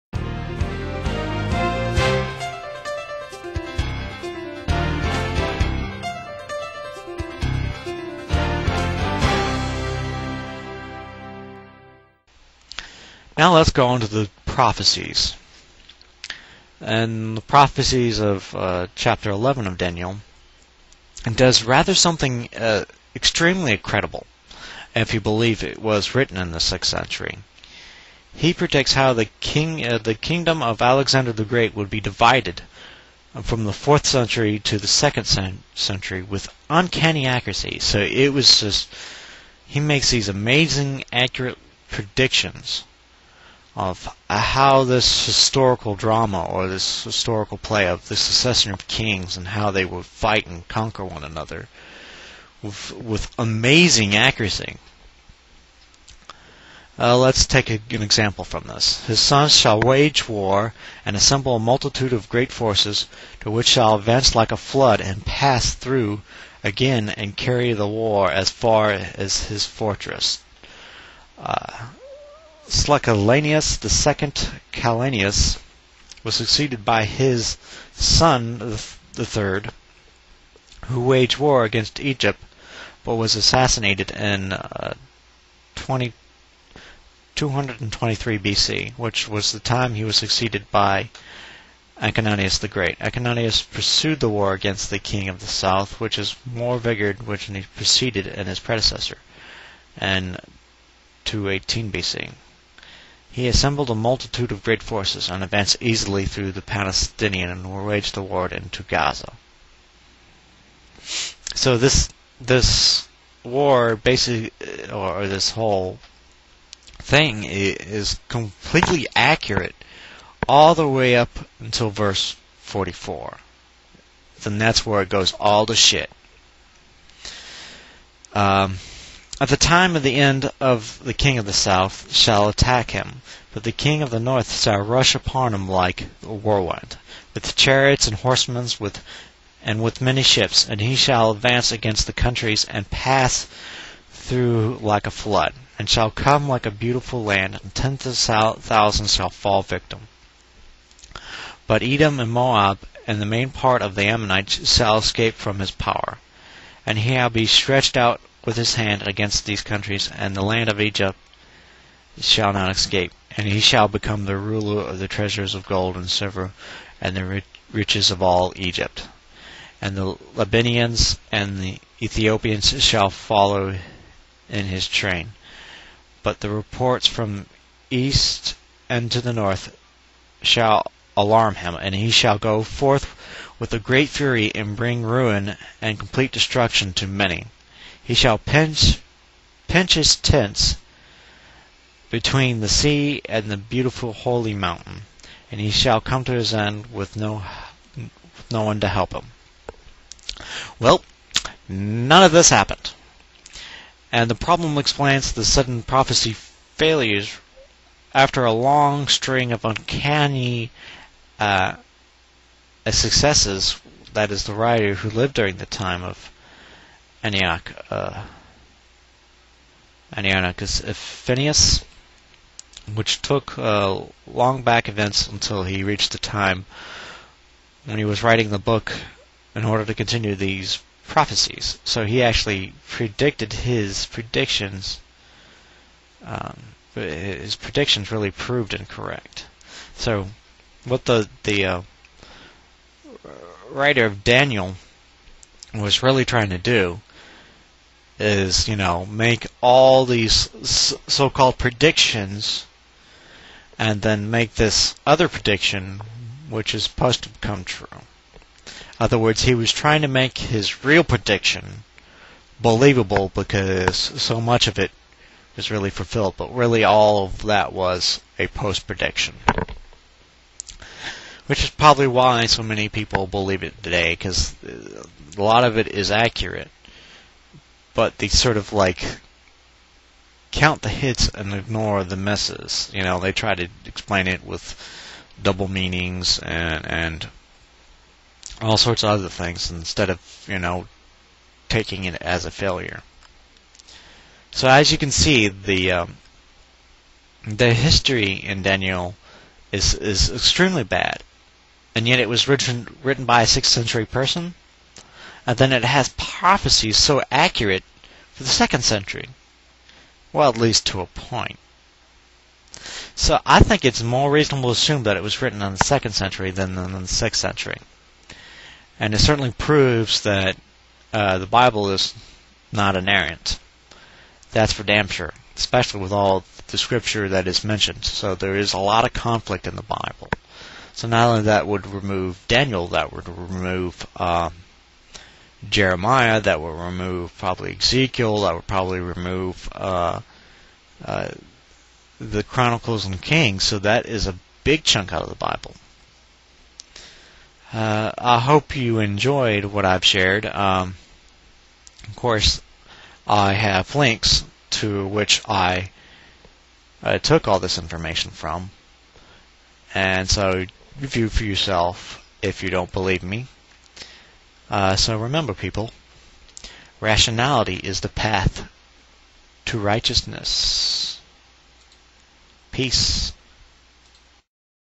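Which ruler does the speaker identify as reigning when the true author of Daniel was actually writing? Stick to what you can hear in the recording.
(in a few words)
Antiochus Epiphanes.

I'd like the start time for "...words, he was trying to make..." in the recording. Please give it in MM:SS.
04:19.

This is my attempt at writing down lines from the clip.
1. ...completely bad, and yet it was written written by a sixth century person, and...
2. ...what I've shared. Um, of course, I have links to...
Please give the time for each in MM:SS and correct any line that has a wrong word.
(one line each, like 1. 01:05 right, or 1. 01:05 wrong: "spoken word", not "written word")
1. 05:00 wrong: "extremely", not "completely"
2. 05:49 right.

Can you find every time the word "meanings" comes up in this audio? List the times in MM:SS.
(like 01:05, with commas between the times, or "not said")
04:45.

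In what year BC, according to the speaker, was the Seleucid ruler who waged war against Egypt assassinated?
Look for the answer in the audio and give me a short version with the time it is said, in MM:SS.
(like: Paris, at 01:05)
223 BC, at 01:27.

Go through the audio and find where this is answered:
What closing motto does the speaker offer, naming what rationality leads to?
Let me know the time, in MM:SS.
06:07.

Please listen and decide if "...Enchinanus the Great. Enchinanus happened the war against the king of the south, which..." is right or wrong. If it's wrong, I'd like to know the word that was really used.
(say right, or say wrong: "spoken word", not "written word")
wrong: "pursued", not "happened".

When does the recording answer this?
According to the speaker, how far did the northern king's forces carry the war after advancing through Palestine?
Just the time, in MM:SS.
01:48.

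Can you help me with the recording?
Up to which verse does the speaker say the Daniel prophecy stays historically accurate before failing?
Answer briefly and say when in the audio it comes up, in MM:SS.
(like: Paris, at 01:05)
44, at 02:01.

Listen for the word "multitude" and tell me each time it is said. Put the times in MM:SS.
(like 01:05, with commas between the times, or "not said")
01:01, 01:43.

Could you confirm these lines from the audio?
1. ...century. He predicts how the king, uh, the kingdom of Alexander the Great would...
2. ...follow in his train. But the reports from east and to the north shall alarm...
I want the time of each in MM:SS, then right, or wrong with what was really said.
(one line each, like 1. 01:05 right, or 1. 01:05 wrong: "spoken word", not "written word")
1. 00:26 right
2. 02:53 right.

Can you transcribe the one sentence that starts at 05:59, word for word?
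And so, view for yourself if you don't believe me.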